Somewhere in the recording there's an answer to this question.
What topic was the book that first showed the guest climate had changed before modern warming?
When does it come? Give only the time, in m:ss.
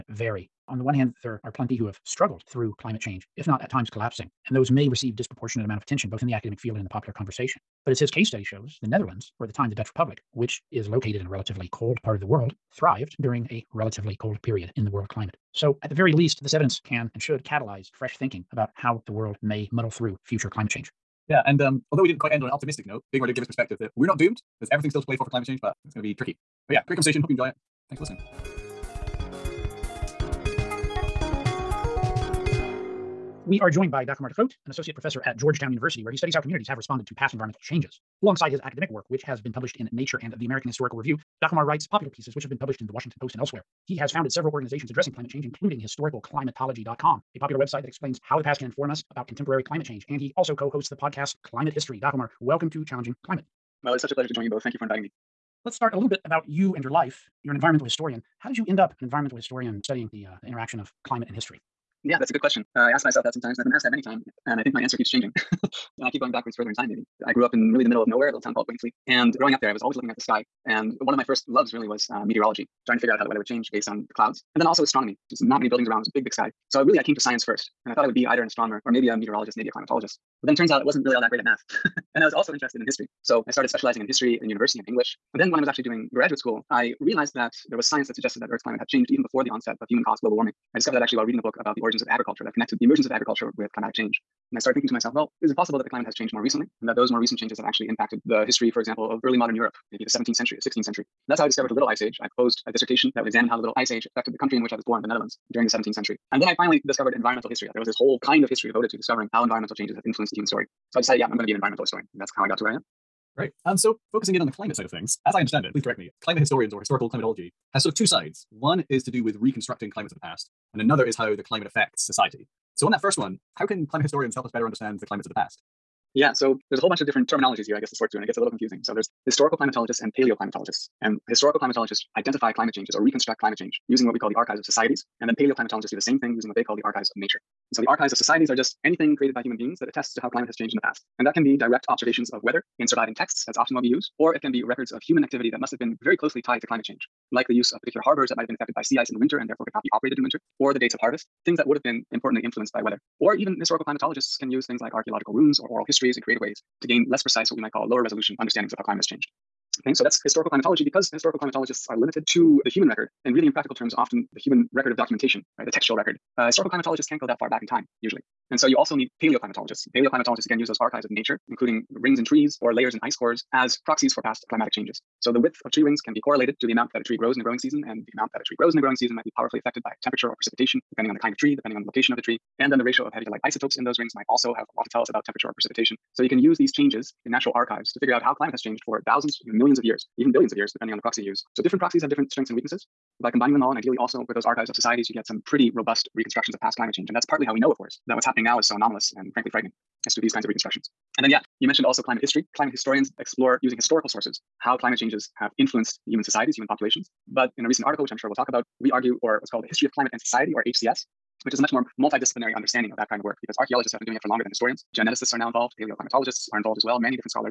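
1:31.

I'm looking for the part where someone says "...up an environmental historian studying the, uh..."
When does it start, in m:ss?
0:58.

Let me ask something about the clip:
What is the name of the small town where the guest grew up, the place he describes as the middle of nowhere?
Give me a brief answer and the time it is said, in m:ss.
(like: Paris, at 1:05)
Wainfleet, at 1:08.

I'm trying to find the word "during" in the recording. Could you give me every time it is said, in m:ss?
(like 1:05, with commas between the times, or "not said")
0:13, 1:45.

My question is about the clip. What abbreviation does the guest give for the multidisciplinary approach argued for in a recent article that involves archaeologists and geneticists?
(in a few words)
HCS.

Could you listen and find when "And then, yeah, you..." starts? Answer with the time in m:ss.
3:21.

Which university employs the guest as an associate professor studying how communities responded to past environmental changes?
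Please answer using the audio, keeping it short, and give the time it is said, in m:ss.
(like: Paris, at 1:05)
Georgetown University, at 0:35.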